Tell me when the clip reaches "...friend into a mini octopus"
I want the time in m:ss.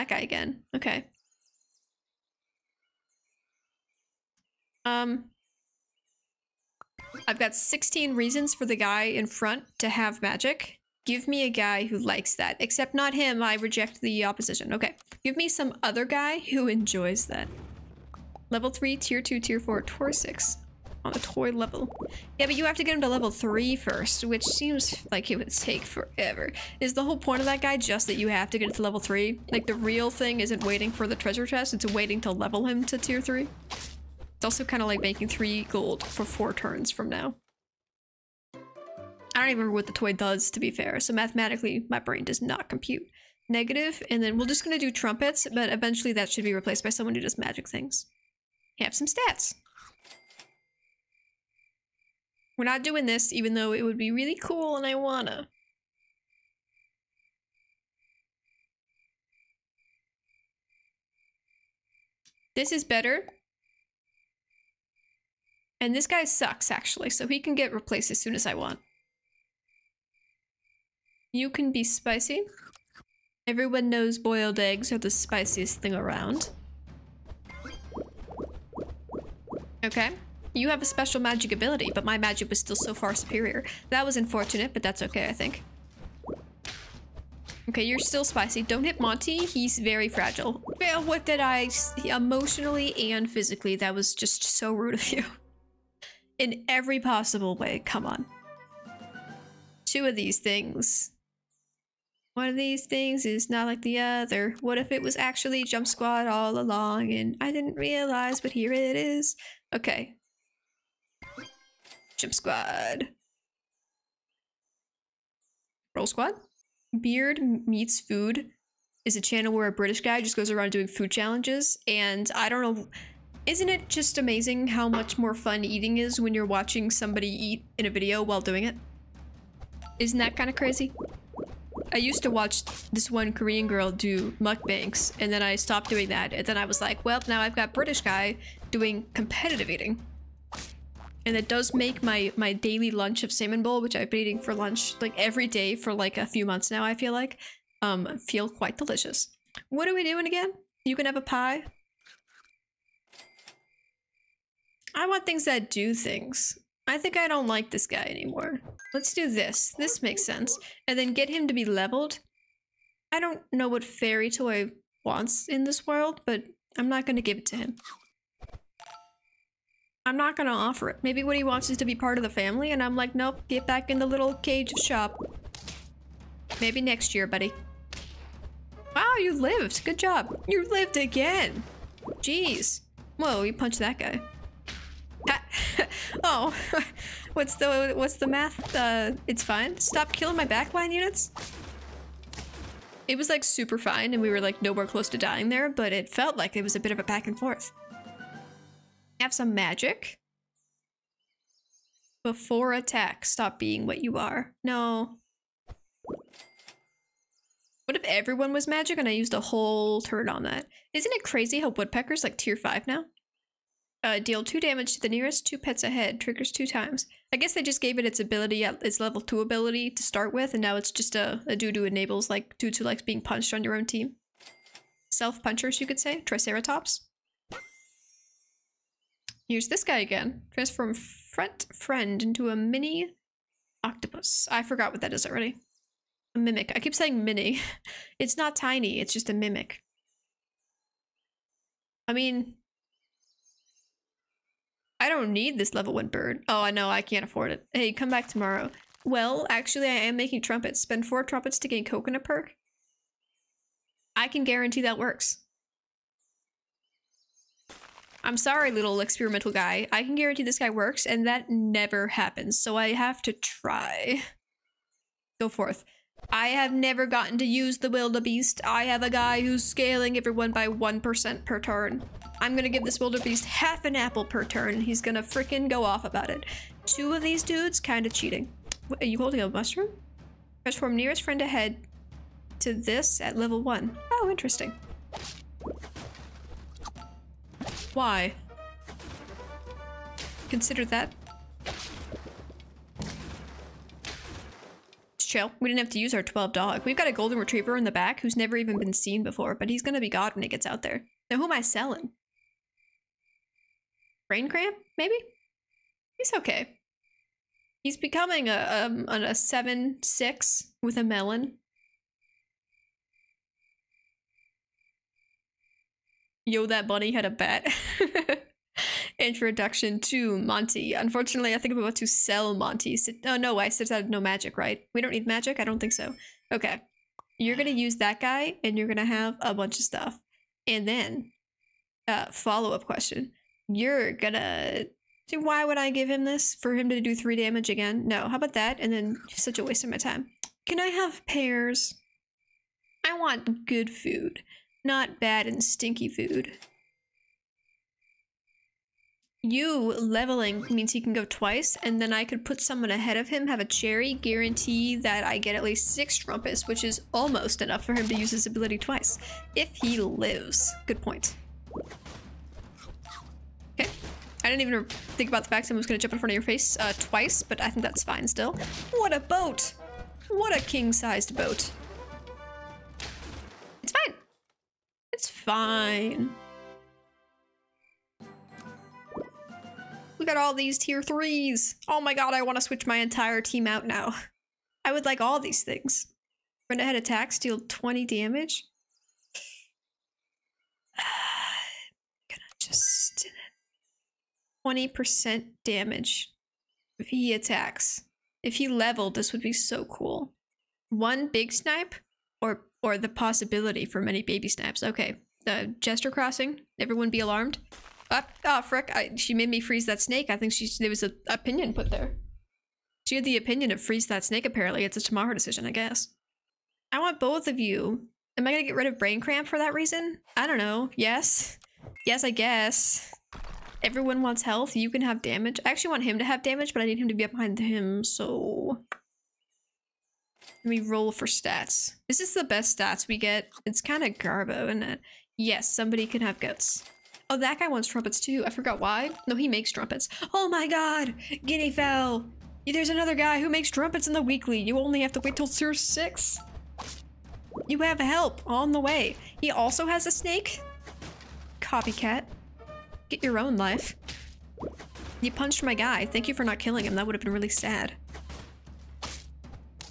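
3:51.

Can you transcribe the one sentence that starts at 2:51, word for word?
Maybe what he wants is to be part of the family, and I'm like, nope, get back in the little cage shop.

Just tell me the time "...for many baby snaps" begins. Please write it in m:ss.
6:43.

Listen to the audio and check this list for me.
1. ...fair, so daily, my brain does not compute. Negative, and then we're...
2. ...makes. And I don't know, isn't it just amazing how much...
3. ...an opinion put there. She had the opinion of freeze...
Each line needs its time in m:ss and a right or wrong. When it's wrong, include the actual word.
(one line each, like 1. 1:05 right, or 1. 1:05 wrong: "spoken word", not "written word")
1. 0:40 wrong: "mathematically", not "daily"
2. 2:01 wrong: "challenges", not "makes"
3. 6:51 right.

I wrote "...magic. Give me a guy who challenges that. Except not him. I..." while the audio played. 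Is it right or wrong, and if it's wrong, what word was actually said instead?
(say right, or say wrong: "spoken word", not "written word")
wrong: "likes", not "challenges".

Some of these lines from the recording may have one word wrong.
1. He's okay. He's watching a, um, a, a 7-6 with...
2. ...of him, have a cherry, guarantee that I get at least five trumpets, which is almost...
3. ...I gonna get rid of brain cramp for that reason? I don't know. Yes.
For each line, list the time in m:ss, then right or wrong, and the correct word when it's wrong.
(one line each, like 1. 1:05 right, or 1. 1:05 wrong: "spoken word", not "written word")
1. 5:06 wrong: "becoming", not "watching"
2. 5:53 wrong: "six", not "five"
3. 6:58 right.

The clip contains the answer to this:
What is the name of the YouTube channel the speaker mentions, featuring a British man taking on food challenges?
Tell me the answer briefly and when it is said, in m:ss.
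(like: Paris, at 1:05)
Beard Meets Food, at 1:56.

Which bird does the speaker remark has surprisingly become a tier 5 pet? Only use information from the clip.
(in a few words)
woodpeckers.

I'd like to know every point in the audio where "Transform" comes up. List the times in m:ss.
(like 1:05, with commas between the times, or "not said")
3:50, 4:40.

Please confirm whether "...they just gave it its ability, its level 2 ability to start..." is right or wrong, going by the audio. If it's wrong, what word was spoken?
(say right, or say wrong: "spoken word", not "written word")
right.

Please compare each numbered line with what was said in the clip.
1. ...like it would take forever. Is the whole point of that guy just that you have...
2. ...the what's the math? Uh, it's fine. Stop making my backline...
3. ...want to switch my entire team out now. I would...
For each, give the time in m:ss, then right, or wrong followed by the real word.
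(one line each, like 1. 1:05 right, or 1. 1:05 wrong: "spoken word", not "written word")
1. 0:25 right
2. 3:07 wrong: "killing", not "making"
3. 6:22 right.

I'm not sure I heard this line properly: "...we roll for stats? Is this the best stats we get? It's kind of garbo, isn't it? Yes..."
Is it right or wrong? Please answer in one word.
right.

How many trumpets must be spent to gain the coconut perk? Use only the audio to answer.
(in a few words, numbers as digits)
4.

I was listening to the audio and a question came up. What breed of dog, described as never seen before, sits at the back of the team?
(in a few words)
golden retriever.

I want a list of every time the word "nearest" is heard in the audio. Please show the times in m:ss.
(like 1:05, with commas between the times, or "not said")
3:35, 4:40.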